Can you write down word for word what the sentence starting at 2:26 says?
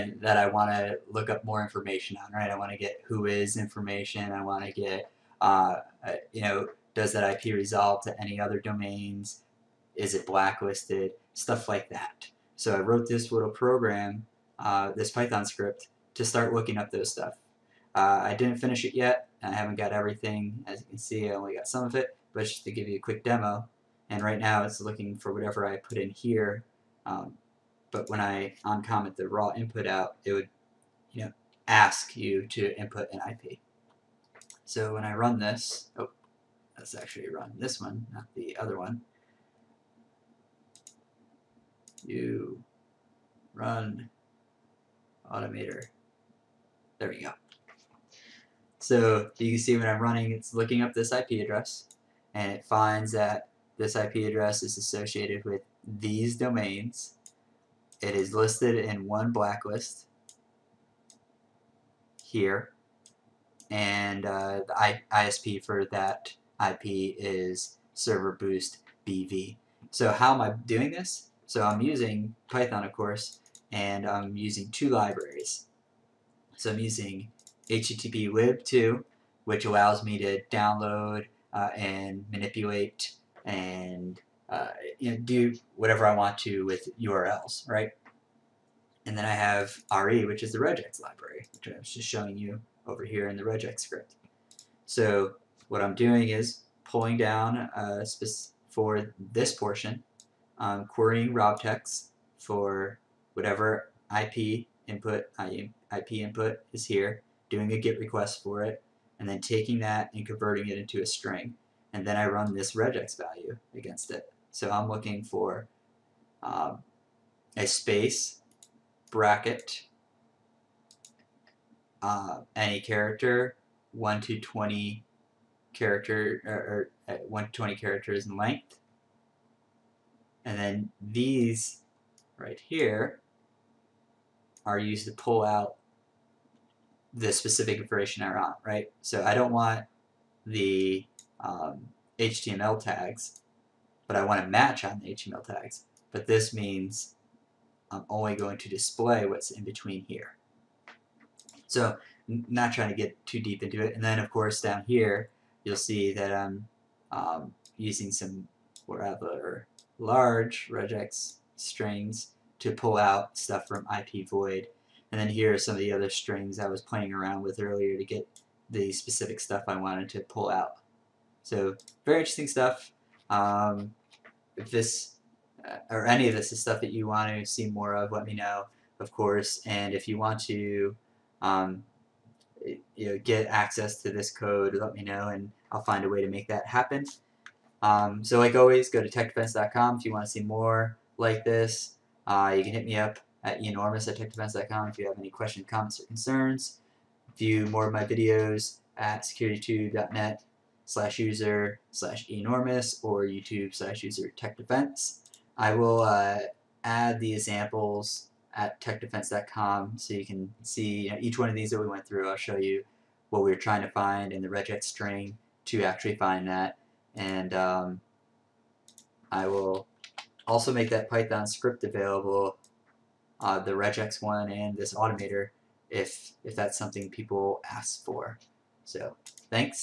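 But this means I'm only going to display what's in between here.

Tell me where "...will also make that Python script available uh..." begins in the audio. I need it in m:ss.
3:39.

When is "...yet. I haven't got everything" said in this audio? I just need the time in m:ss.
0:18.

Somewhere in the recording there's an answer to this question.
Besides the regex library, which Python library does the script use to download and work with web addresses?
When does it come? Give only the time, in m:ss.
1:17.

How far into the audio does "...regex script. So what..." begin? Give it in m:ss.
1:33.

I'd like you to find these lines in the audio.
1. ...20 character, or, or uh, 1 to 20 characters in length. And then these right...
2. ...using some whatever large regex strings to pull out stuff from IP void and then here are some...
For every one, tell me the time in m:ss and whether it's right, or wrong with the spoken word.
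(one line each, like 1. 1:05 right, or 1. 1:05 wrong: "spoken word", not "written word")
1. 2:04 right
2. 2:37 right.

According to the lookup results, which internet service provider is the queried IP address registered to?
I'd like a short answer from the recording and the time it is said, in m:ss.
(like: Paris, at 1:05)
Server Boost BV, at 1:07.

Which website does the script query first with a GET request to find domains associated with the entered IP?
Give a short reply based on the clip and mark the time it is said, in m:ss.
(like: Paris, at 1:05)
Robtex, at 1:41.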